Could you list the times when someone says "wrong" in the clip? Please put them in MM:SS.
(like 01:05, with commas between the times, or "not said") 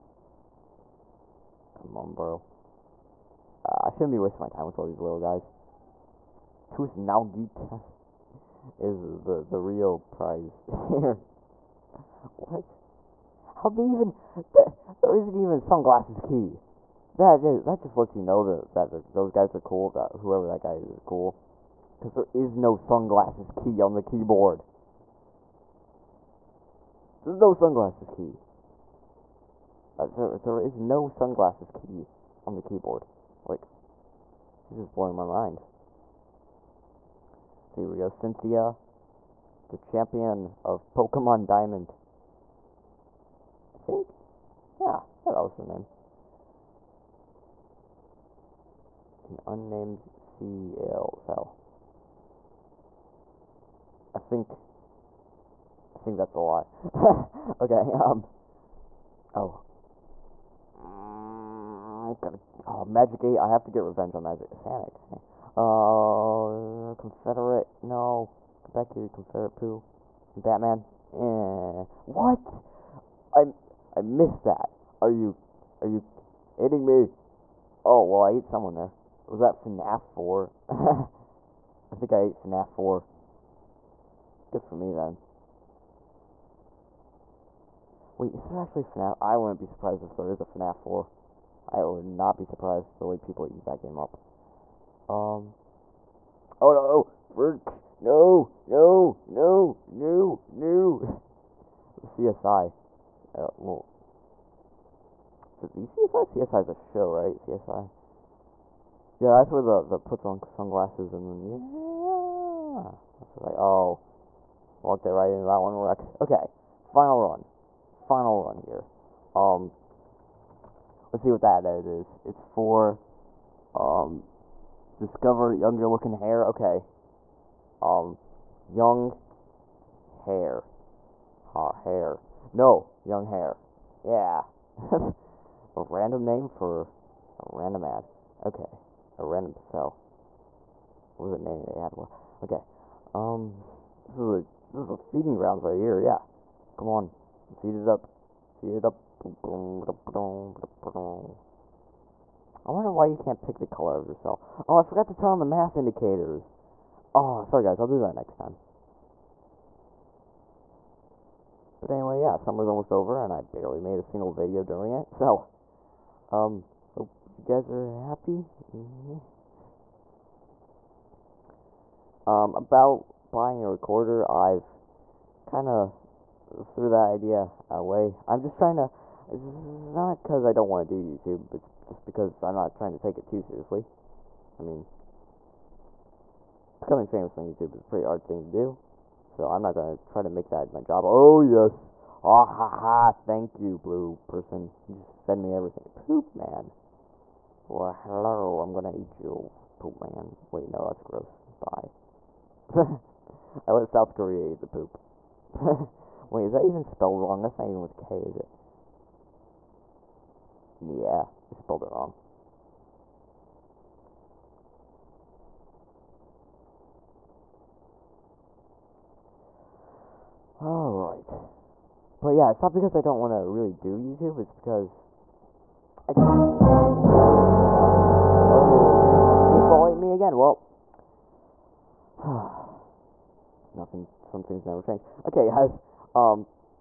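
03:27, 03:31.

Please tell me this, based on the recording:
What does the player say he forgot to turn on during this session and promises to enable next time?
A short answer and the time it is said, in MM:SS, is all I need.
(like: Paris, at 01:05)
mass indicators, at 02:35.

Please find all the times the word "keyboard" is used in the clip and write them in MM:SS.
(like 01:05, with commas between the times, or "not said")
00:24, 00:32.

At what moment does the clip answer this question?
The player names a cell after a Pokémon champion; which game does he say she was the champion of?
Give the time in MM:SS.
00:40.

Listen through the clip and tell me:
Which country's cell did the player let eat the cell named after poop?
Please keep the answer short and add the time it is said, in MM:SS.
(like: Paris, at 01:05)
South Korea, at 03:23.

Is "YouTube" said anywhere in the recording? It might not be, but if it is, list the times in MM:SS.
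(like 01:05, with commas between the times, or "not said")
03:01, 03:07, 03:43.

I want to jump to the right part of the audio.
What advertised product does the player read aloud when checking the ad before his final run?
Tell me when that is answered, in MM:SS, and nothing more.
02:05.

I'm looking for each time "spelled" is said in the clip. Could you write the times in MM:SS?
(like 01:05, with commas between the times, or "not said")
03:26, 03:31.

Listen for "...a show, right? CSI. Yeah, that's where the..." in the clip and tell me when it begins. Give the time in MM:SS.
01:46.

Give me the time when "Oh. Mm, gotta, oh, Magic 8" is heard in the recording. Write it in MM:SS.
00:59.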